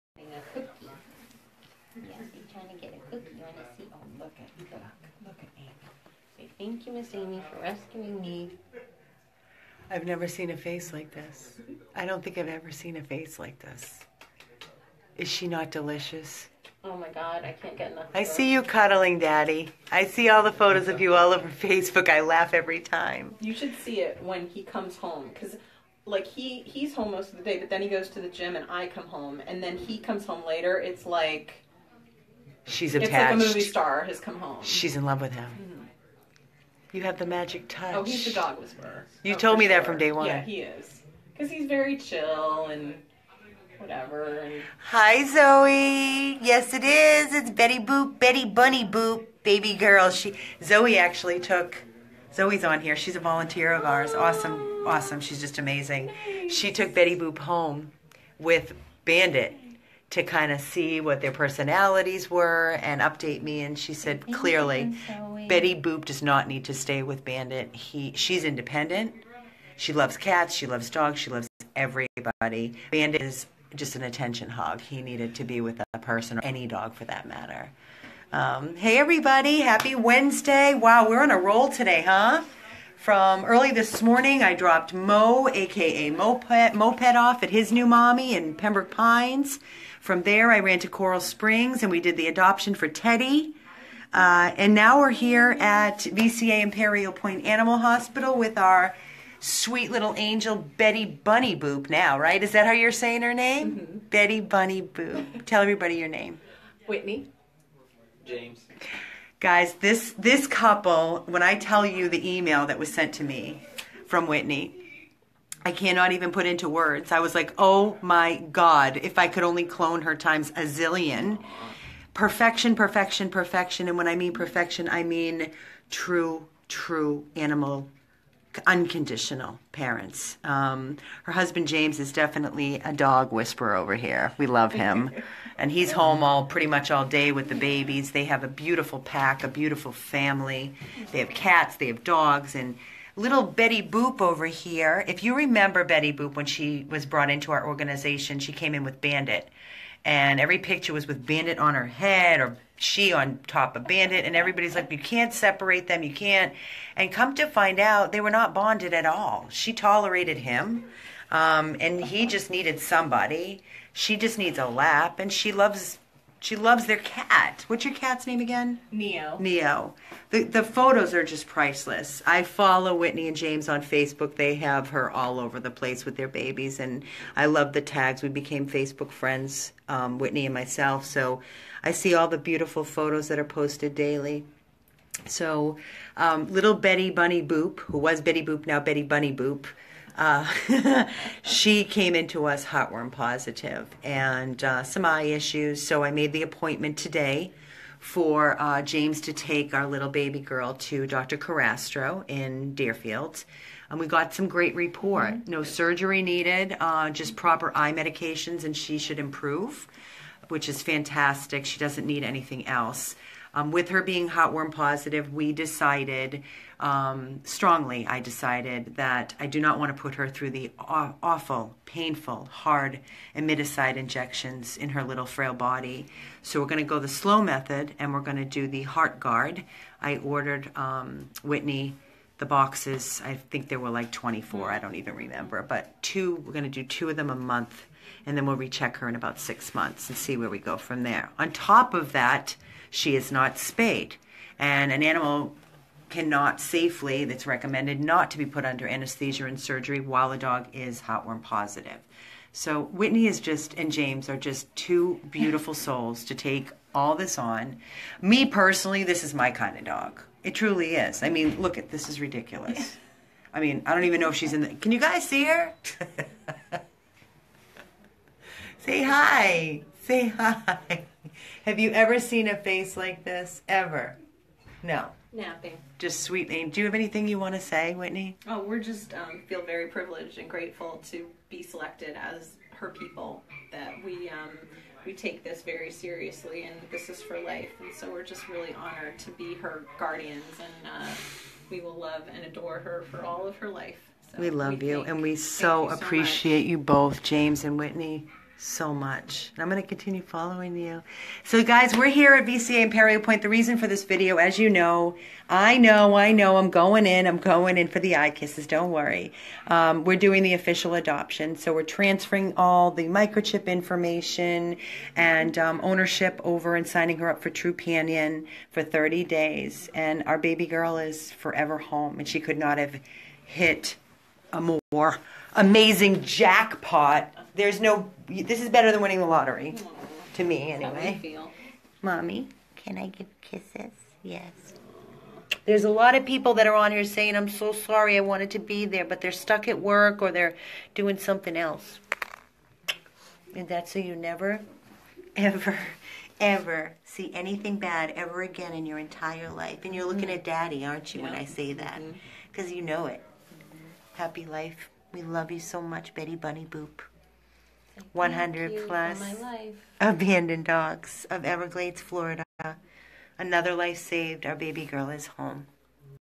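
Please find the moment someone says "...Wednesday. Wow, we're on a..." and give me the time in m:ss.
1:19.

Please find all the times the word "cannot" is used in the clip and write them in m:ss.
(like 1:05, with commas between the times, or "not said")
1:55, 4:06.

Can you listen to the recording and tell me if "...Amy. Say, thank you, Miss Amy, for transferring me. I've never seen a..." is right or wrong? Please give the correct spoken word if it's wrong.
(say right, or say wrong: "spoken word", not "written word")
wrong: "rescuing", not "transferring".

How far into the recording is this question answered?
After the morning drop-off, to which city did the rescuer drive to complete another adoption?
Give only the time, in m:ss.
1:30.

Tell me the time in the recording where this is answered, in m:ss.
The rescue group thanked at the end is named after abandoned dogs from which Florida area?
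6:01.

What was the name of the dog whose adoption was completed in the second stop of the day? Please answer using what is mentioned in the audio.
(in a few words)
Teddy.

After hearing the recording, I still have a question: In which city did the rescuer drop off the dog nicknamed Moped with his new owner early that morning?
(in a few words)
Pembroke Pines.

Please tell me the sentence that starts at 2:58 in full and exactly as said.
We became Facebook friends, um, Whitney and myself.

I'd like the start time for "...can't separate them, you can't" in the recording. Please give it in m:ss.
2:34.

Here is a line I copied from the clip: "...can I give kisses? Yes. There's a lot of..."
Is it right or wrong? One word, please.
right.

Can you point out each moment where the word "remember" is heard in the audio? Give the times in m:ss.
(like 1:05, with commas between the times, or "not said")
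2:25, 3:55.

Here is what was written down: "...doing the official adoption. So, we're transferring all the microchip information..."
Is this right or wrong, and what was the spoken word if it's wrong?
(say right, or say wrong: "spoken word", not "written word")
right.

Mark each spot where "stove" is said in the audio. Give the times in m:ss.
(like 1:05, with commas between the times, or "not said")
not said.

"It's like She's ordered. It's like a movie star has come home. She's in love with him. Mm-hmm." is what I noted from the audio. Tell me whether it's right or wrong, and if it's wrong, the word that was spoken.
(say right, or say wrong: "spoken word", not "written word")
wrong: "attached", not "ordered".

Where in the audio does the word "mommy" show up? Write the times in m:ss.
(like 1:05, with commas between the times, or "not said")
1:27, 5:32.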